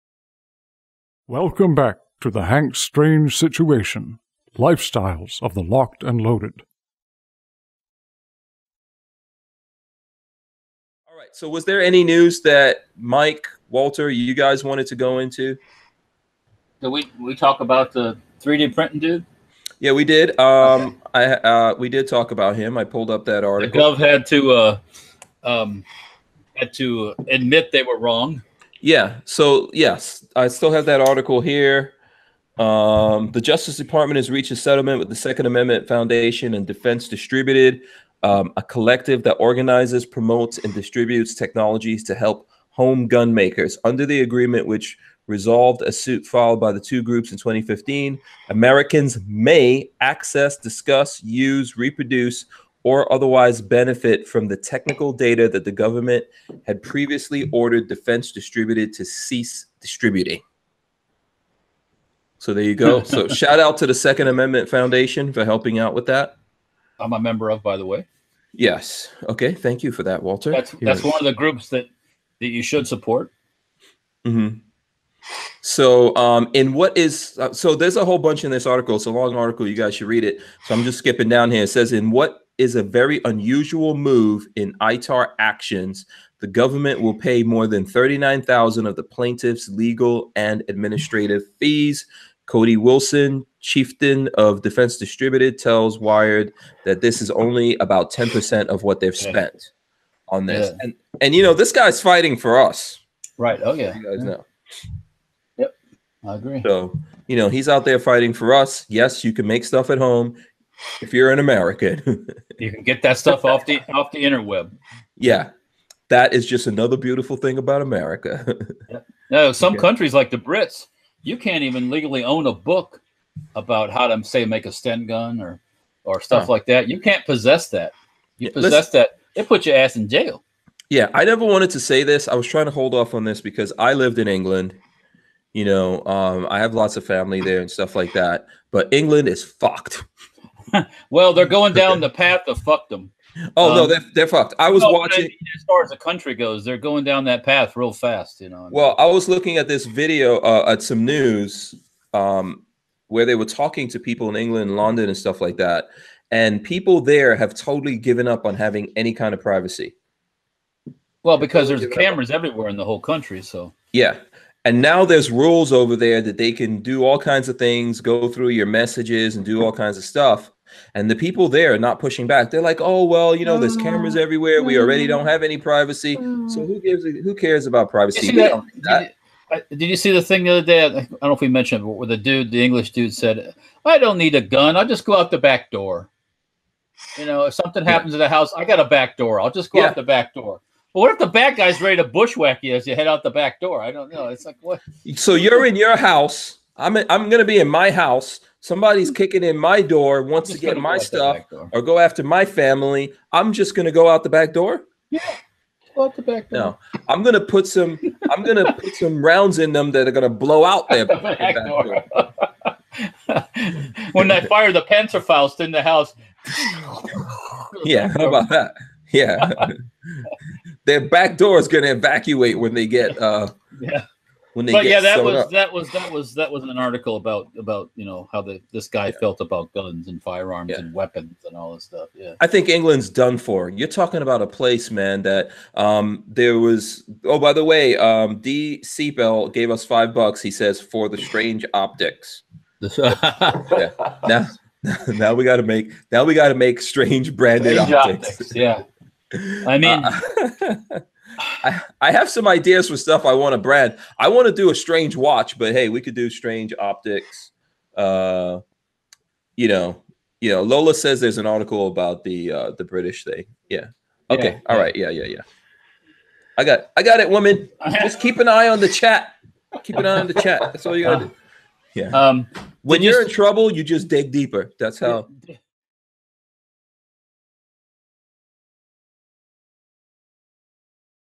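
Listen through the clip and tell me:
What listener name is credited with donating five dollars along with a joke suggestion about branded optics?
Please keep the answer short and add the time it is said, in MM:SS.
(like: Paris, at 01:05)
D Seatbell, at 03:58.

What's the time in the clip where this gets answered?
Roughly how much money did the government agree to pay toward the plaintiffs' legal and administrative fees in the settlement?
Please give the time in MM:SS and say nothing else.
01:27.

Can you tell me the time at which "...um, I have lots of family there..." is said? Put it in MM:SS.
02:16.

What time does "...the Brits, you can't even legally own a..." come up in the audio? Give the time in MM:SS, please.
02:00.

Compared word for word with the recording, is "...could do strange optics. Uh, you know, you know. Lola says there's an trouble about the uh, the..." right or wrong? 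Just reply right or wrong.
wrong.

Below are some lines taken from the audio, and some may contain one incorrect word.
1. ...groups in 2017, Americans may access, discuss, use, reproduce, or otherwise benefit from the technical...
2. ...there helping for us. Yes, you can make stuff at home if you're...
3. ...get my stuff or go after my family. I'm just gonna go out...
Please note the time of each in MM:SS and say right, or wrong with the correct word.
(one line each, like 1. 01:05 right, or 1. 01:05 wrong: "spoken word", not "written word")
1. 00:47 wrong: "2015", not "2017"
2. 01:47 wrong: "fighting", not "helping"
3. 03:20 right.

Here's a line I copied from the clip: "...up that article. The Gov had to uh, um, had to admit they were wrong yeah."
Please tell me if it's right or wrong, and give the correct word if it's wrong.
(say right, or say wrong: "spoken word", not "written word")
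right.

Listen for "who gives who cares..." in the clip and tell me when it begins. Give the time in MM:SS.
02:56.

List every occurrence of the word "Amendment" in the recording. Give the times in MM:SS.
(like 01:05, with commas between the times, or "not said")
00:35, 01:04.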